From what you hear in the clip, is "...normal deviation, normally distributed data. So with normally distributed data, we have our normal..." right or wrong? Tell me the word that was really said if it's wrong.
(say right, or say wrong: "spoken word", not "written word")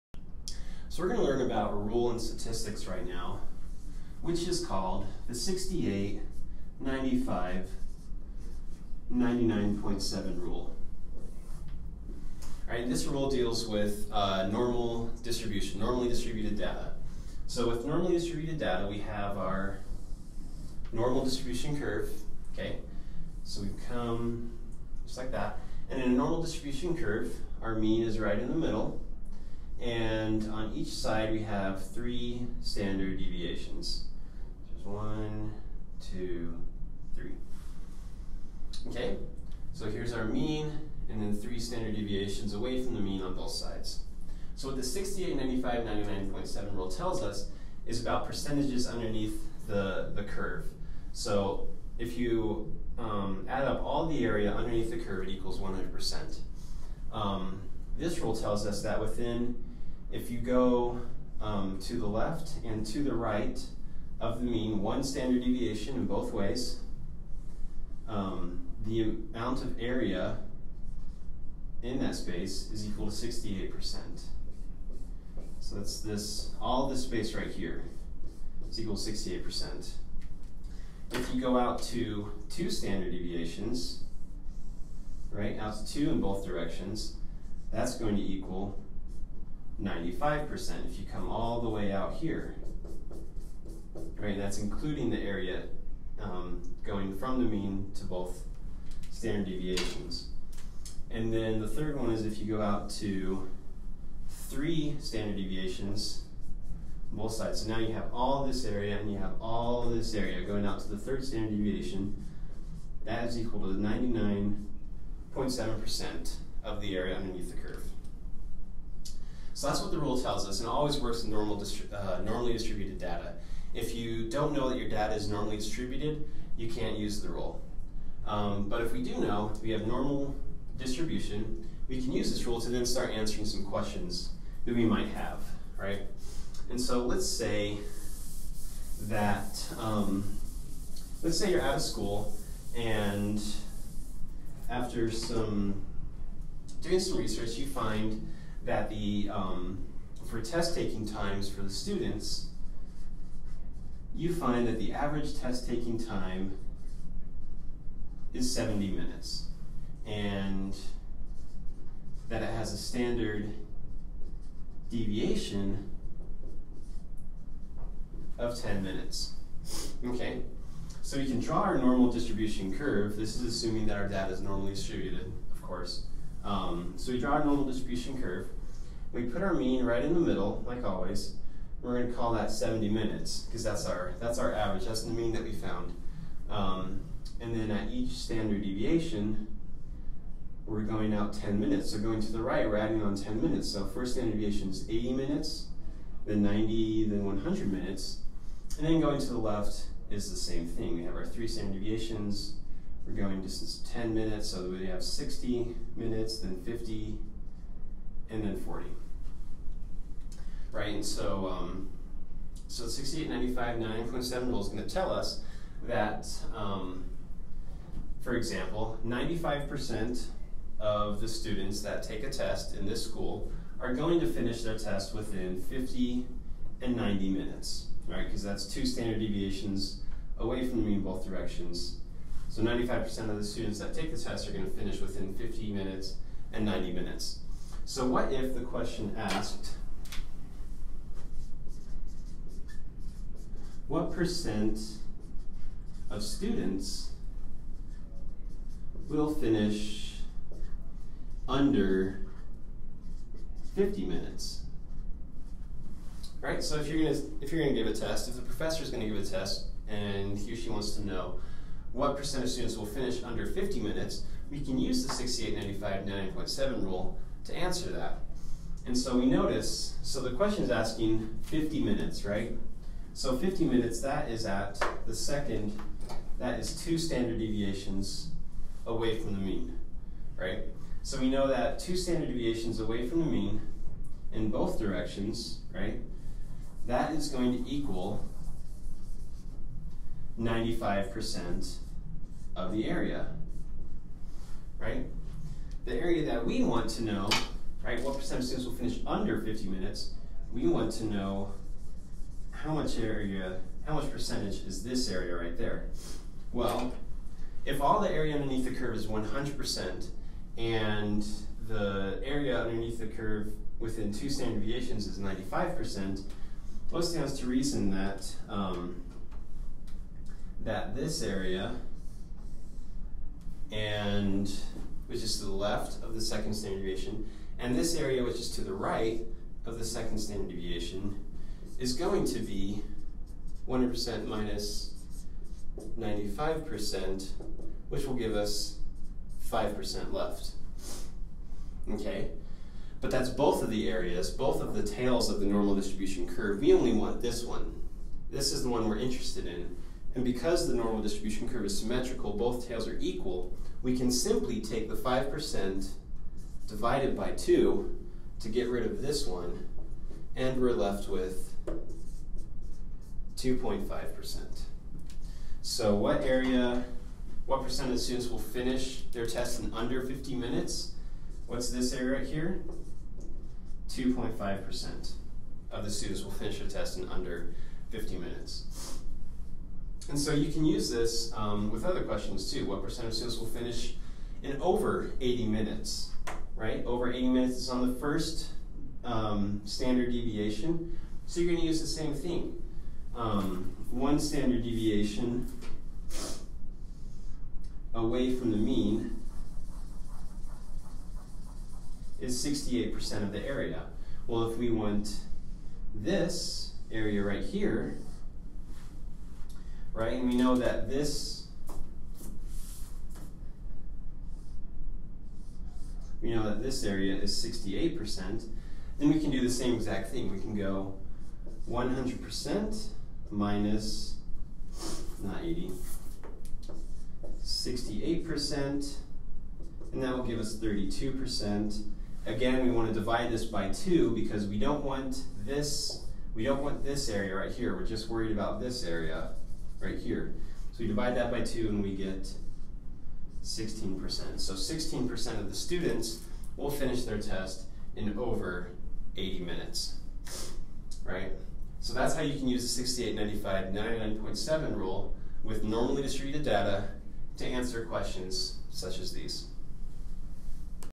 wrong: "distribution", not "deviation".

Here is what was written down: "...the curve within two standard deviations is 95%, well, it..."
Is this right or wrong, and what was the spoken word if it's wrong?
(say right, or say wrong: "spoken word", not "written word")
right.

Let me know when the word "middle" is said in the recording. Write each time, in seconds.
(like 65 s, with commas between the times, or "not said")
28 s, 180 s.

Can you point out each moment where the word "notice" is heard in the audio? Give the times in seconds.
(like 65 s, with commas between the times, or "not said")
269 s.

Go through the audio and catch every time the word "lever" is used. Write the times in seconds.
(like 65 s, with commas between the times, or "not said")
not said.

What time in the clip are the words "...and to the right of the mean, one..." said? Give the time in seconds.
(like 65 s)
62 s.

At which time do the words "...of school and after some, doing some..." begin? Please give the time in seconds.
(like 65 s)
141 s.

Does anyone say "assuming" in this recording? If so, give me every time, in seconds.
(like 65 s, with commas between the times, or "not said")
173 s.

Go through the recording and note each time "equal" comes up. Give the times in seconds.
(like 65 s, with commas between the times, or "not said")
55 s, 72 s, 78 s, 88 s, 113 s, 287 s, 352 s.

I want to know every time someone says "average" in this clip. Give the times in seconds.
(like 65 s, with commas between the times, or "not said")
154 s, 184 s.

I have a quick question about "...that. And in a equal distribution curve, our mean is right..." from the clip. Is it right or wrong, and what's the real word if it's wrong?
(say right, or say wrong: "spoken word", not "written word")
wrong: "normal", not "equal".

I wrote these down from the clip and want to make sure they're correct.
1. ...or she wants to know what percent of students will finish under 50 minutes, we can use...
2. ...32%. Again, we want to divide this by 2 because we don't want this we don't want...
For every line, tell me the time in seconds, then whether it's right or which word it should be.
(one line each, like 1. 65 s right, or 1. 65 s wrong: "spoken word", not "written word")
1. 260 s right
2. 430 s right.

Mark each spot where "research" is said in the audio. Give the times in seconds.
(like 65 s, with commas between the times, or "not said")
147 s.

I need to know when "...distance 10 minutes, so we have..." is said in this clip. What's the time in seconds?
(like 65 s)
203 s.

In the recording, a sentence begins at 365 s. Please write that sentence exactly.
So what area, what percent of the students will finish their test in under 50 minutes?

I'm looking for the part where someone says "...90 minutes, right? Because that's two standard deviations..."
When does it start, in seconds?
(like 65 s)
226 s.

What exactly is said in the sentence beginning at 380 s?
And so you can use this um, with other questions too.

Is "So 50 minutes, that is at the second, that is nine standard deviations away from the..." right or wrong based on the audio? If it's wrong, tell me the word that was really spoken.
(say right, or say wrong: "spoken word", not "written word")
wrong: "two", not "nine".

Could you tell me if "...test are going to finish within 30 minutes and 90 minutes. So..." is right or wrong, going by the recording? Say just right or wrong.
wrong.